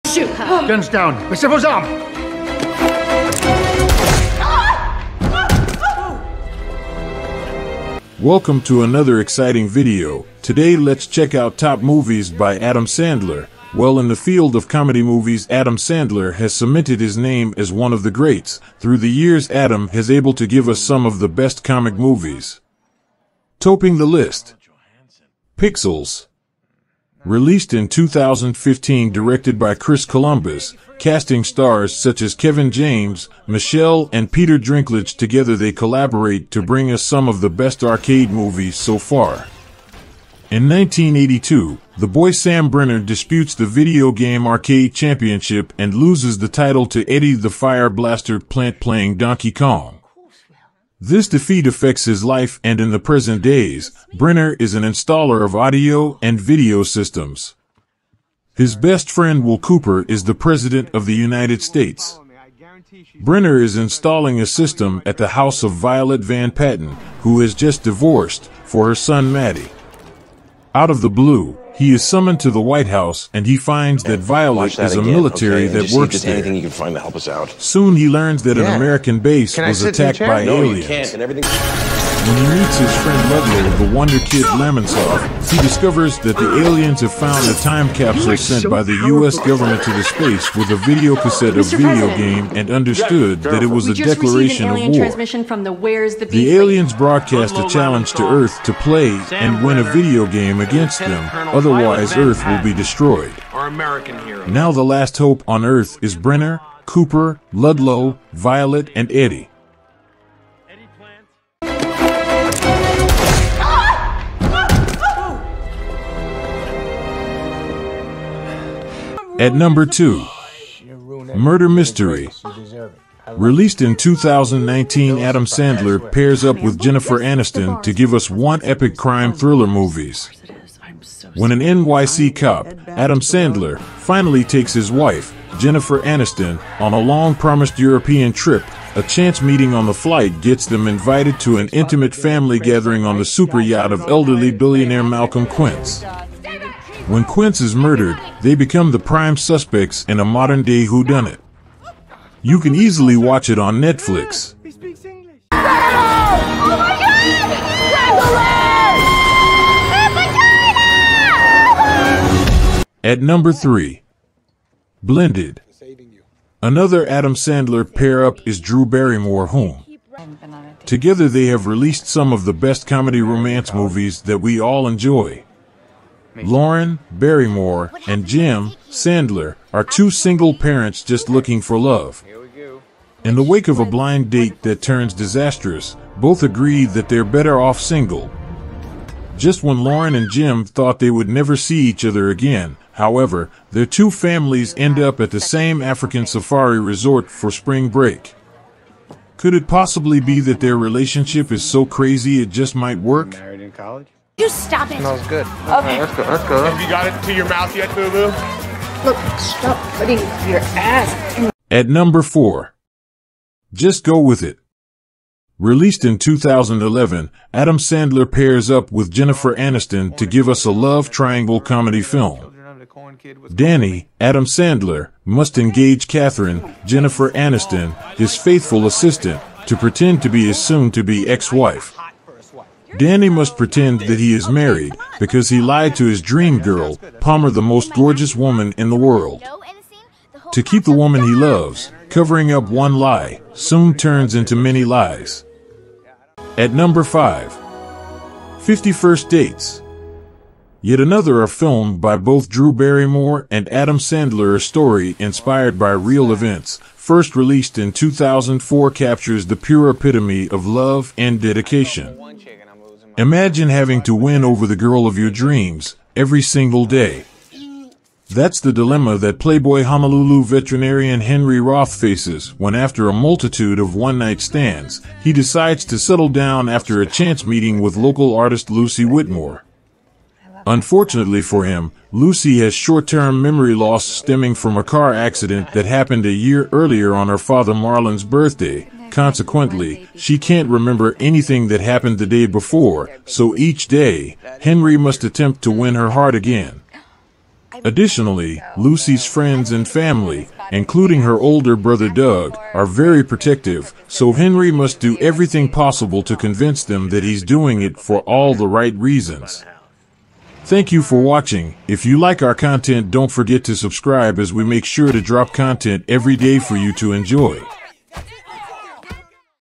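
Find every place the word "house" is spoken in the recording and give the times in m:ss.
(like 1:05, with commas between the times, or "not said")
1:05, 1:12.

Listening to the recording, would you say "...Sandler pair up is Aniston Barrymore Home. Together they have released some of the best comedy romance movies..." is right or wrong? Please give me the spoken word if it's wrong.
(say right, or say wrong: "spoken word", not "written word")
wrong: "Drew", not "Aniston".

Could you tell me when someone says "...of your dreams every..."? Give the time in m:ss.
4:25.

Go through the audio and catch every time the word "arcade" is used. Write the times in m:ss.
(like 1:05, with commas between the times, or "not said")
0:37, 0:44.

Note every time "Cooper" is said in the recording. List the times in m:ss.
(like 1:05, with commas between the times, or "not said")
0:59, 1:46.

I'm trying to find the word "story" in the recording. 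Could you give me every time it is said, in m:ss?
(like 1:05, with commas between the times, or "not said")
4:14.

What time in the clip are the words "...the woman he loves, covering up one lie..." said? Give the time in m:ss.
4:00.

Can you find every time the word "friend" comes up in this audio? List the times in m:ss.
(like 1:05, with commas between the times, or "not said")
0:59, 1:23, 4:59.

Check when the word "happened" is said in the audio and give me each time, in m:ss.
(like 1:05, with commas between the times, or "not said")
4:45, 4:51.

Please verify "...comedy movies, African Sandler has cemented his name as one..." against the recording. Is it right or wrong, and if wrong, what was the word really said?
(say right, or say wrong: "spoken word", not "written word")
wrong: "Adam", not "African".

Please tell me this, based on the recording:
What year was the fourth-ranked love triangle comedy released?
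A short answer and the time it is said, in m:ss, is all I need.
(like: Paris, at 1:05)
2011, at 3:36.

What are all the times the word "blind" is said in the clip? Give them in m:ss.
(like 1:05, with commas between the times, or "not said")
3:03.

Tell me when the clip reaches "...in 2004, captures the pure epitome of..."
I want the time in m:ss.
4:17.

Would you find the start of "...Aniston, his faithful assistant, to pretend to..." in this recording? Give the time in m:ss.
3:47.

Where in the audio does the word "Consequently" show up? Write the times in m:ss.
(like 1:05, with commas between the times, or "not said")
4:49.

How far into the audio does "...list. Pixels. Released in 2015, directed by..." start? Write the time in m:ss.
0:24.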